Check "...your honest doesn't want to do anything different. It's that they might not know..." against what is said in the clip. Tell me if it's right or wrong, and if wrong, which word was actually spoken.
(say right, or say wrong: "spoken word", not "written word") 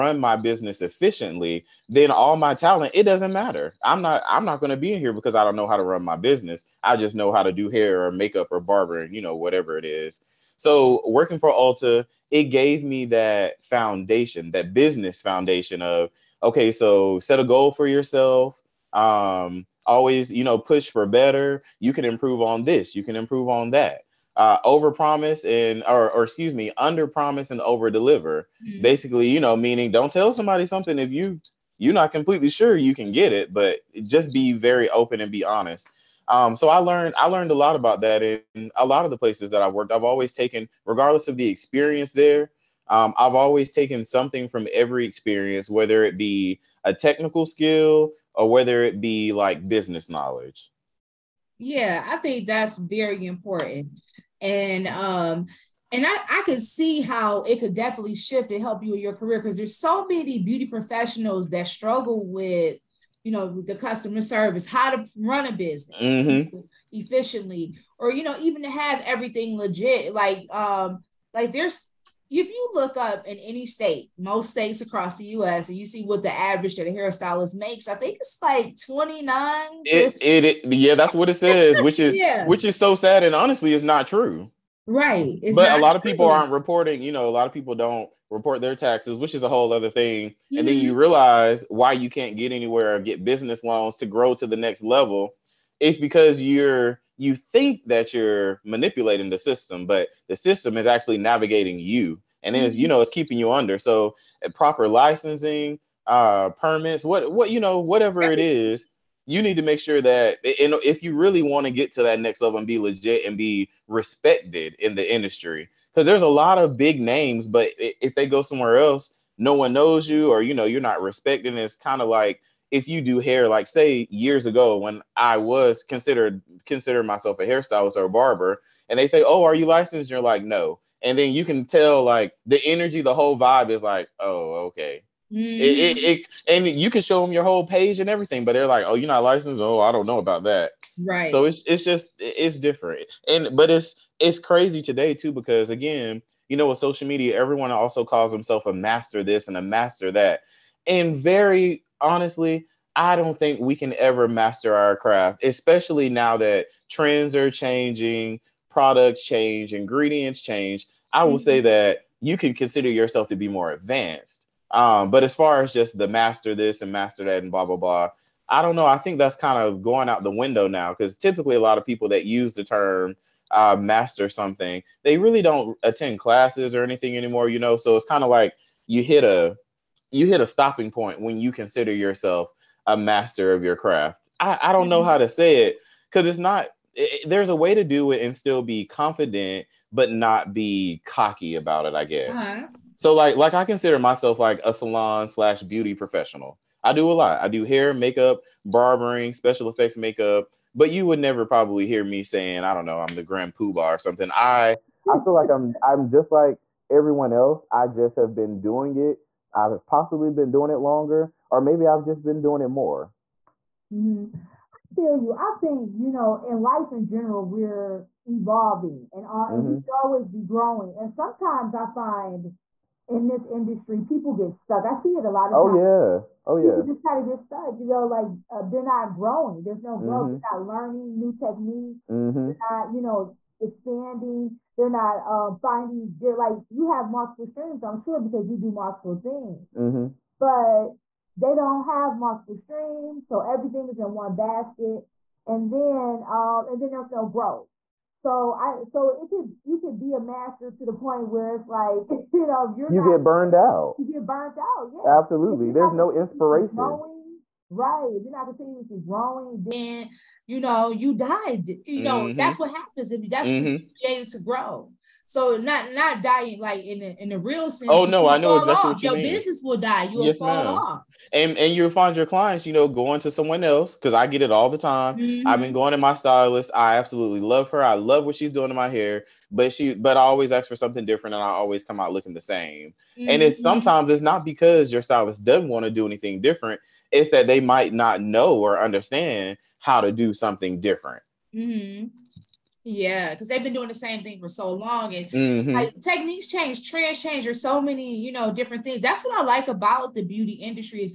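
wrong: "stylist", not "honest".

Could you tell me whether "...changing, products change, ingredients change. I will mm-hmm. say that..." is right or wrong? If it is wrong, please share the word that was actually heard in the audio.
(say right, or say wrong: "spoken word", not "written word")
right.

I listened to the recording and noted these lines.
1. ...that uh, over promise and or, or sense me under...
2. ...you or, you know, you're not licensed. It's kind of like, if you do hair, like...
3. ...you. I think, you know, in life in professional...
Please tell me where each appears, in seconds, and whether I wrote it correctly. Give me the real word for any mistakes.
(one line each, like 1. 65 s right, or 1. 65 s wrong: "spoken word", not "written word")
1. 23 s wrong: "excuse", not "sense"
2. 120 s wrong: "respected", not "licensed"
3. 215 s wrong: "general", not "professional".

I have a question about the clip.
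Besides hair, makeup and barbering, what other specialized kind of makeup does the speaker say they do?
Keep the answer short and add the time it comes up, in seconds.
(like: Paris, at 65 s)
special effects makeup, at 199 s.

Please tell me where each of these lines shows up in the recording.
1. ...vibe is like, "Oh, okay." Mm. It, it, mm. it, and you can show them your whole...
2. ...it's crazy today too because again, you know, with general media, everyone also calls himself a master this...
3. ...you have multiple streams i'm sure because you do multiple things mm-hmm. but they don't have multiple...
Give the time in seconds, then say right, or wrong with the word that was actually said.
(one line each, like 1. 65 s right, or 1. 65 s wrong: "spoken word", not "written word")
1. 133 s right
2. 144 s wrong: "social", not "general"
3. 236 s right.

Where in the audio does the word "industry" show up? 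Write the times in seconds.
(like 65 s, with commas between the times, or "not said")
115 s, 223 s, 300 s.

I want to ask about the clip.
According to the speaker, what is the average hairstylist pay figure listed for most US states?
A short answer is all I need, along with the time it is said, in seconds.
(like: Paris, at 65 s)
29, at 78 s.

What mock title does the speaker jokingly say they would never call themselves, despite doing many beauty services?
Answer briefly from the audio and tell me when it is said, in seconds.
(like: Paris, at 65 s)
grand poobah, at 203 s.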